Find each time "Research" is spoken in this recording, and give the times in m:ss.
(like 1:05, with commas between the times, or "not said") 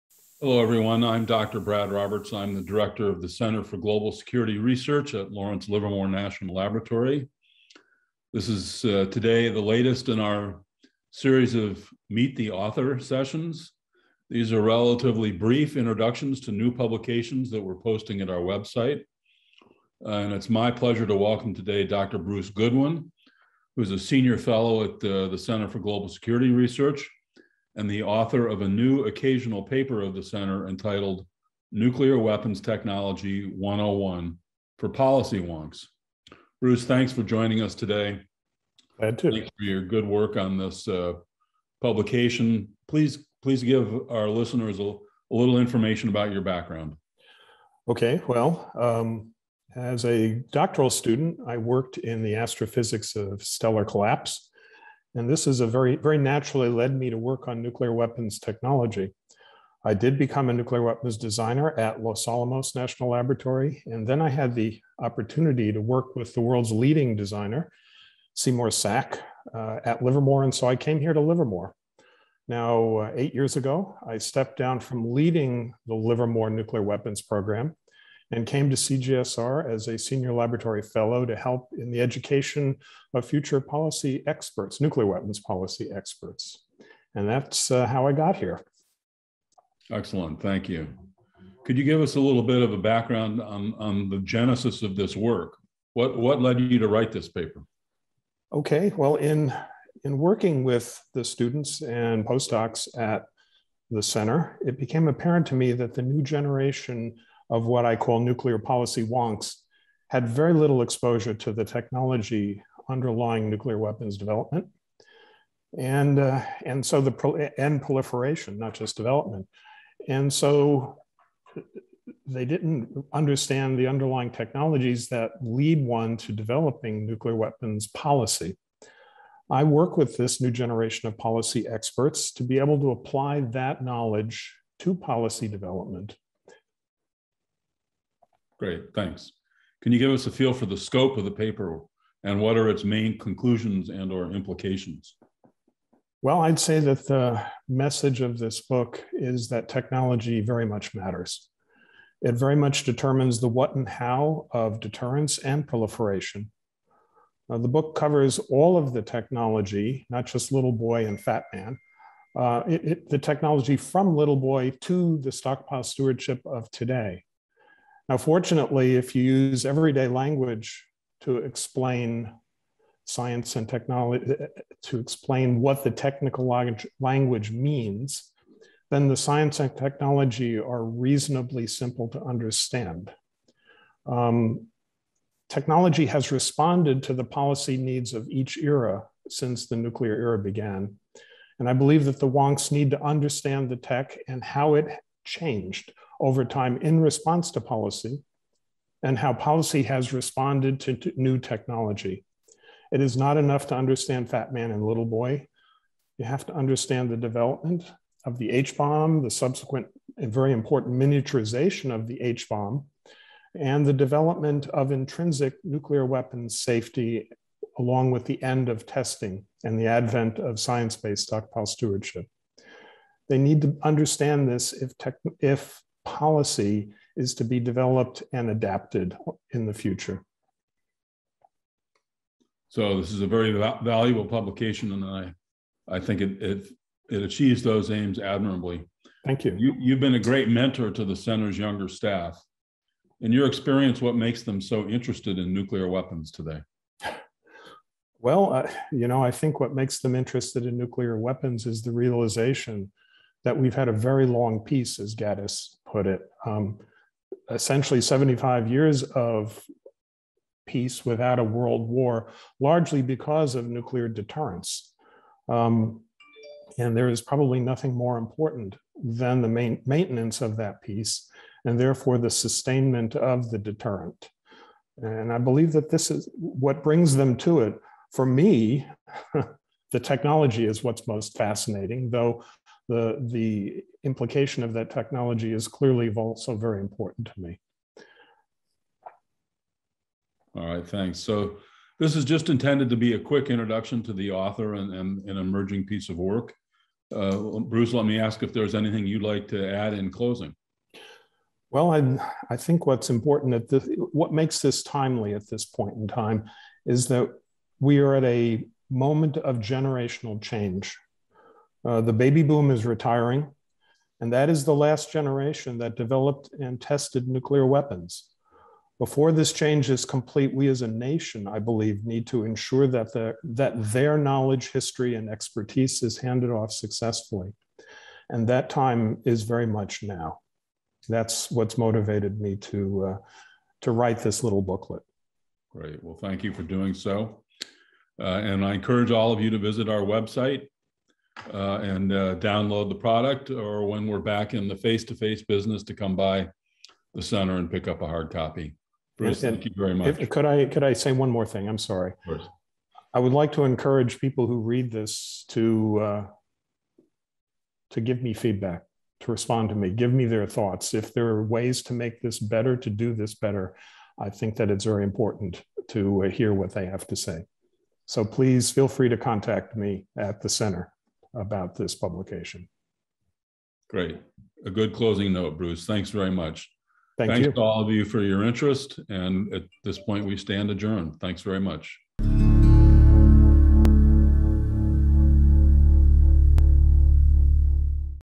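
0:04, 0:26.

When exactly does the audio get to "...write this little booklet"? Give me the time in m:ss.
5:33.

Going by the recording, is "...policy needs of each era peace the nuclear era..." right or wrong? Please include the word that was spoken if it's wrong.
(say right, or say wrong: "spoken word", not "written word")
wrong: "since", not "peace".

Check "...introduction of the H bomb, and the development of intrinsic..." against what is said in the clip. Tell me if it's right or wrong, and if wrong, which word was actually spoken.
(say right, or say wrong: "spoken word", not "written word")
wrong: "miniaturization", not "introduction".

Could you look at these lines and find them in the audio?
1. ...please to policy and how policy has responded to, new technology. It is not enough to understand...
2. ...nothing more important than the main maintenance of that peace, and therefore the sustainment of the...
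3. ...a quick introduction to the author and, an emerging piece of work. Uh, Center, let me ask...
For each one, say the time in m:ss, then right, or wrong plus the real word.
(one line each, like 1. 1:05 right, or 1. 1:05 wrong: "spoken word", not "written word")
1. 3:17 wrong: "response", not "please"
2. 4:27 right
3. 4:53 wrong: "Bruce", not "Center".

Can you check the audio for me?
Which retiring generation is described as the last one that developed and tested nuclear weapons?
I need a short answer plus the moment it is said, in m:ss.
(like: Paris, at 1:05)
Baby boom, at 5:12.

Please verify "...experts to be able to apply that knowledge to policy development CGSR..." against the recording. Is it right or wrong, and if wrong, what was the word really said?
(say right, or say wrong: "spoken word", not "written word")
wrong: "Great", not "CGSR".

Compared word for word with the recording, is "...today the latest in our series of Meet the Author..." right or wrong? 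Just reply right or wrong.
right.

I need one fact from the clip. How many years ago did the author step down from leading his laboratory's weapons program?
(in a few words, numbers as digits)
8.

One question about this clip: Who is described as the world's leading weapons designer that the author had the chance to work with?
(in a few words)
Seymour Sack.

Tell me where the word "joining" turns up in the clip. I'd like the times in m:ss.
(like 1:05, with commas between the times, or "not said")
0:37.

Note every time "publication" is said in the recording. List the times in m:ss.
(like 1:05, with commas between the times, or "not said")
0:16, 0:41, 3:54, 6:11.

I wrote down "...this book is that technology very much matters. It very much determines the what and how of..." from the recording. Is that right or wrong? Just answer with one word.
right.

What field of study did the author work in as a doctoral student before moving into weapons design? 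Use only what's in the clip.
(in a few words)
Astrophysics of stellar collapse.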